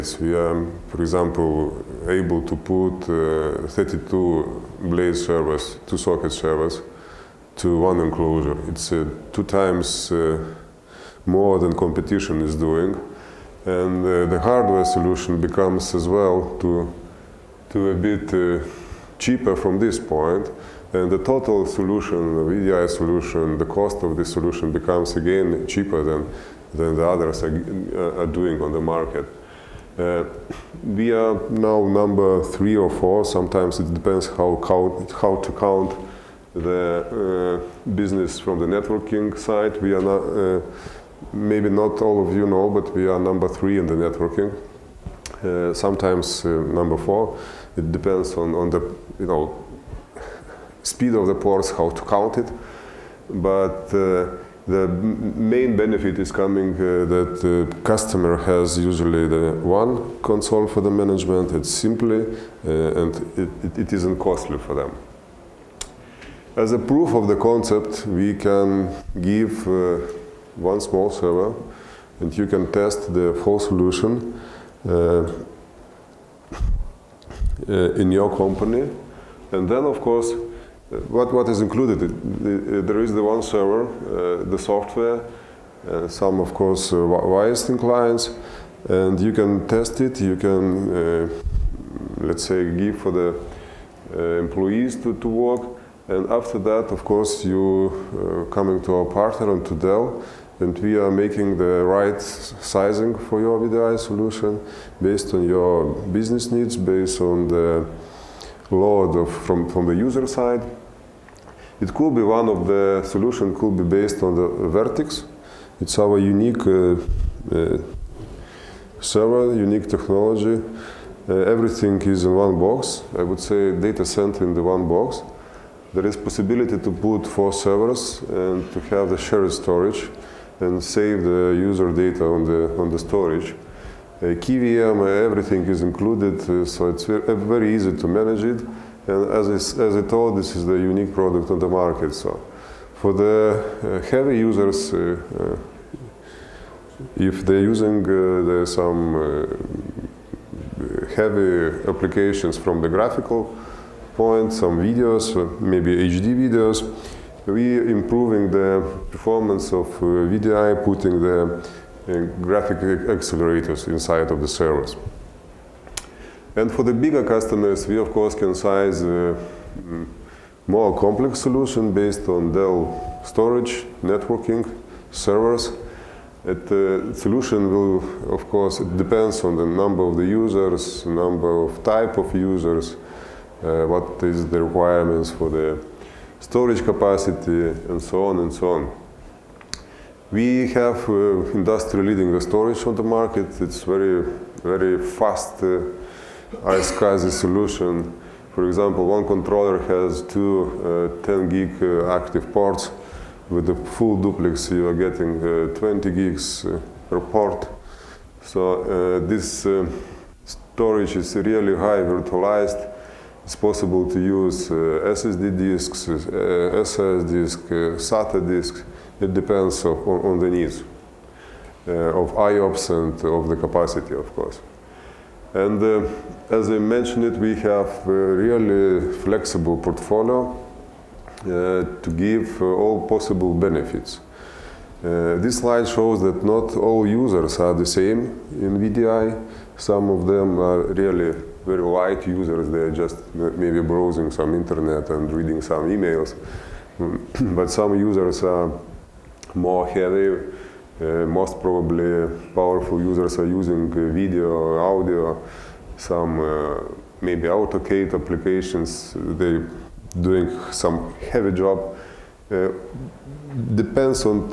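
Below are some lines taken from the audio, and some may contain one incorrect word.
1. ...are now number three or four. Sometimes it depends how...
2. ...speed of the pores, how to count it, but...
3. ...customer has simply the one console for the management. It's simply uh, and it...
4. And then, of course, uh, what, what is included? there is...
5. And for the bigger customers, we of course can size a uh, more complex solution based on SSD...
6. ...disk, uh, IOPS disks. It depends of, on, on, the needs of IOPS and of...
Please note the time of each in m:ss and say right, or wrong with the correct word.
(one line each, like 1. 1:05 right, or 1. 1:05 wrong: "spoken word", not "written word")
1. 0:31 right
2. 0:50 right
3. 0:57 wrong: "usually", not "simply"
4. 1:19 right
5. 2:46 wrong: "Dell", not "SSD"
6. 3:37 wrong: "SATA", not "IOPS".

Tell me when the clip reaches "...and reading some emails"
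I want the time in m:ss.
4:05.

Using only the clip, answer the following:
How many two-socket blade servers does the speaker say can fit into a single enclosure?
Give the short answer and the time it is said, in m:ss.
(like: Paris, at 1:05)
32, at 0:03.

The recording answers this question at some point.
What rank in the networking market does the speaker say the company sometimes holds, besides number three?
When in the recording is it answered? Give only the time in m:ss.
0:46.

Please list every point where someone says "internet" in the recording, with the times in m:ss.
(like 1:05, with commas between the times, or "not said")
4:04.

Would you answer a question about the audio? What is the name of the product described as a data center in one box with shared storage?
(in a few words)
VRTX.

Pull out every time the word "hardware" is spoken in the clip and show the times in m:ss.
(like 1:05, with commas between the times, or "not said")
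0:14.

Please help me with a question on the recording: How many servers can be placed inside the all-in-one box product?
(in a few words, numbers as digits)
4.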